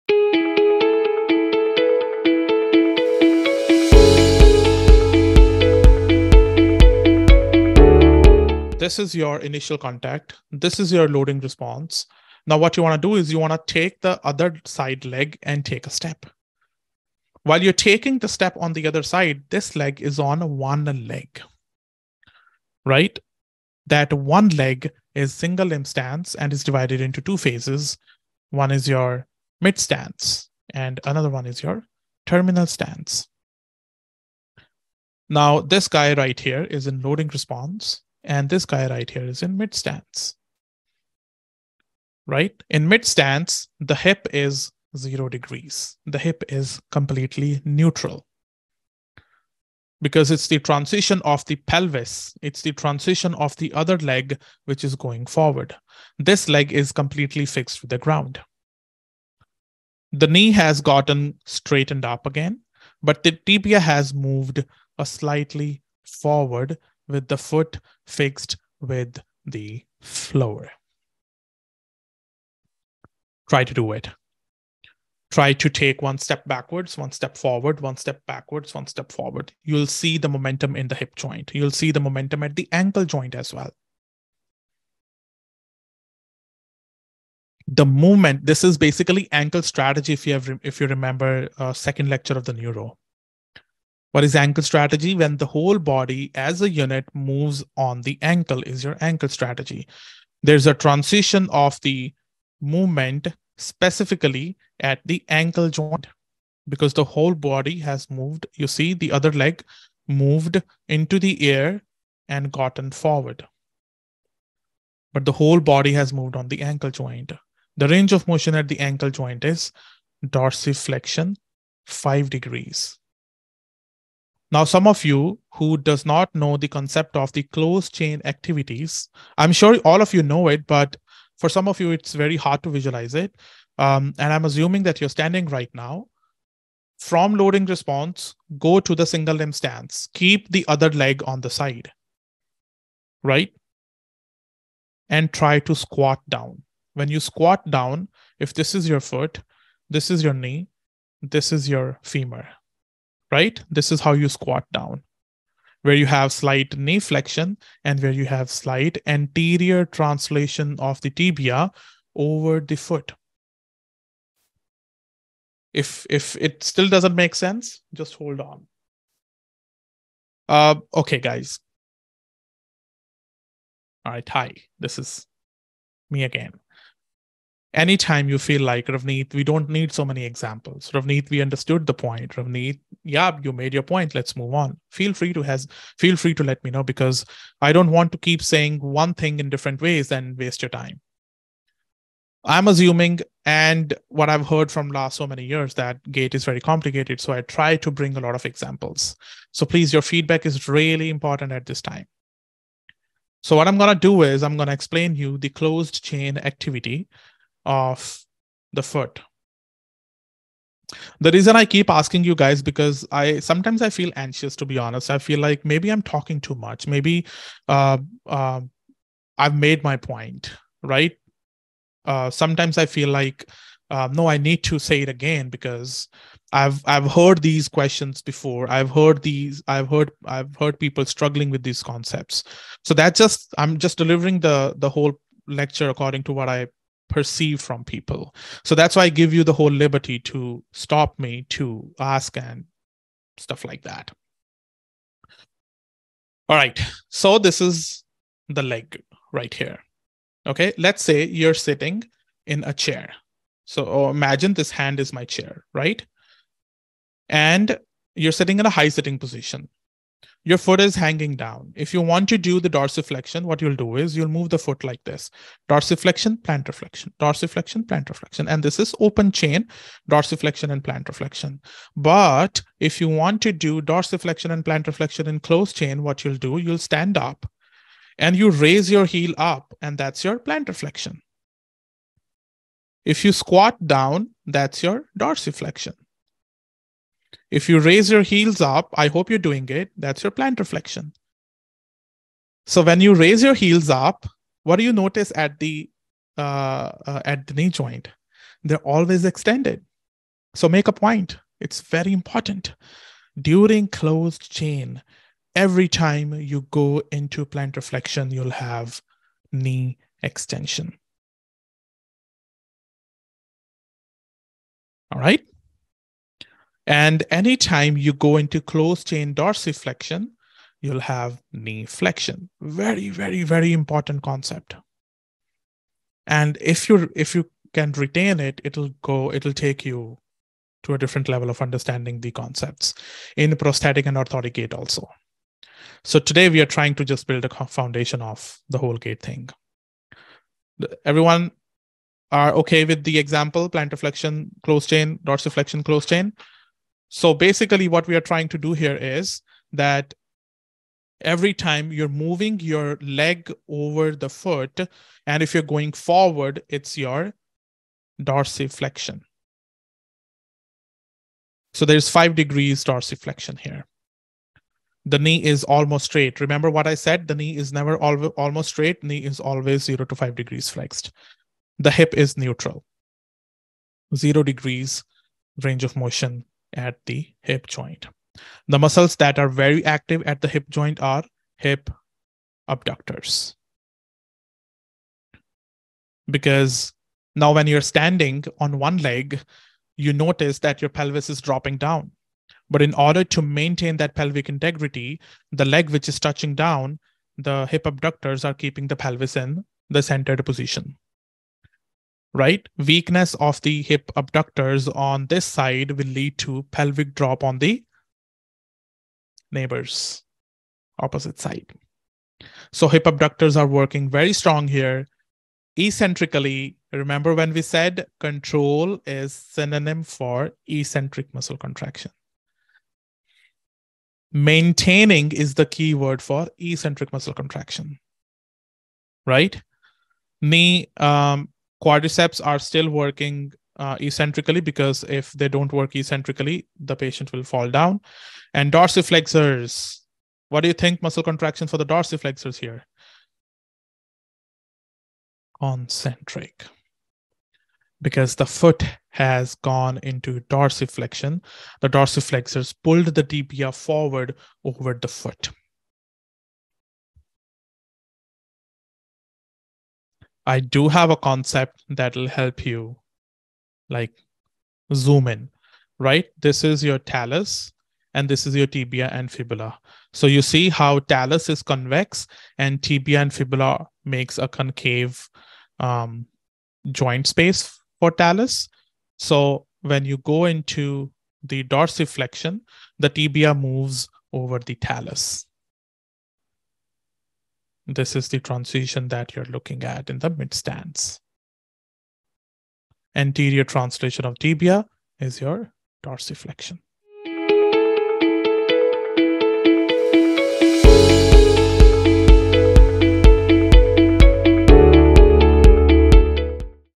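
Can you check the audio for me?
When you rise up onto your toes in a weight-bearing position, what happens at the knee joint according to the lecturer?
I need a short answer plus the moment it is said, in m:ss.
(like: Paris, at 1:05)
Knee extension, at 5:09.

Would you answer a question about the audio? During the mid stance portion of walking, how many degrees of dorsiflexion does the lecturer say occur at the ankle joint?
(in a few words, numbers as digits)
5 degrees.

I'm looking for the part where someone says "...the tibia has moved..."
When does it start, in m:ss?
1:03.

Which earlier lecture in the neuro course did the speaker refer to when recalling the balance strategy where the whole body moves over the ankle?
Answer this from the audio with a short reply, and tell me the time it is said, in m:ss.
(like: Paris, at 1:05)
Second lecture, at 1:31.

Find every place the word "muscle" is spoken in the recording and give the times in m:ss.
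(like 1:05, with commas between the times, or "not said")
6:18, 7:01, 7:07, 7:21.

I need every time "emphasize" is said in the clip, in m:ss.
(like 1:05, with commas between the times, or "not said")
not said.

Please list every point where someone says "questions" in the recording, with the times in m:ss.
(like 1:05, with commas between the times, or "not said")
3:47.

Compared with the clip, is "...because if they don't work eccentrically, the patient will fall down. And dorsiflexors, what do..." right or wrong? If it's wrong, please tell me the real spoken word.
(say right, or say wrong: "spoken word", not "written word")
right.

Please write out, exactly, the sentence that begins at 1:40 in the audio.
There's a transition of the movement specifically at the ankle joint because the whole body has moved.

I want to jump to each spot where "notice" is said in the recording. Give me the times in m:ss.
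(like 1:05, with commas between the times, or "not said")
4:54, 6:30.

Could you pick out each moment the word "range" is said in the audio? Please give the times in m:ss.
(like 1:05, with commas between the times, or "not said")
1:57, 6:15.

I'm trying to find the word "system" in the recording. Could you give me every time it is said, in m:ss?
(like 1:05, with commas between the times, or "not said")
not said.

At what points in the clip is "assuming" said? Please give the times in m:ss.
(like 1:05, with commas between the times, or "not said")
2:14, 3:12.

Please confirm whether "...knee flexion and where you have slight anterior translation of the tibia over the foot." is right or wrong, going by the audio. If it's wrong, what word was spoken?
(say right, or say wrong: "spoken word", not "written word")
right.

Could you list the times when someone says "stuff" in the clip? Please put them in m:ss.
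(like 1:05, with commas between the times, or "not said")
4:03.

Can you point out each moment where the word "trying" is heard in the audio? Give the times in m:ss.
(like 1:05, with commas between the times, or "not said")
5:36, 5:48.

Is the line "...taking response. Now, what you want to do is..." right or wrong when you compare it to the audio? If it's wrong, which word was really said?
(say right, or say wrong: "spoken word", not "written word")
wrong: "loading", not "taking".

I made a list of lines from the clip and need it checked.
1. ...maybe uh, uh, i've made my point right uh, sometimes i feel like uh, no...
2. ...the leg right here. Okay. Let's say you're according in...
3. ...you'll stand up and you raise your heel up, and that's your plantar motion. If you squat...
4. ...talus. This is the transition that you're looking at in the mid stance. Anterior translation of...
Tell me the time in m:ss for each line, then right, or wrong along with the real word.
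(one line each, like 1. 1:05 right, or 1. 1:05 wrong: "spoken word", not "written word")
1. 3:36 right
2. 4:08 wrong: "sitting", not "according"
3. 4:36 wrong: "flexion", not "motion"
4. 8:04 right.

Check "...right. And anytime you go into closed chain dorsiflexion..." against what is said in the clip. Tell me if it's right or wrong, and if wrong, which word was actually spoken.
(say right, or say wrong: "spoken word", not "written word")
right.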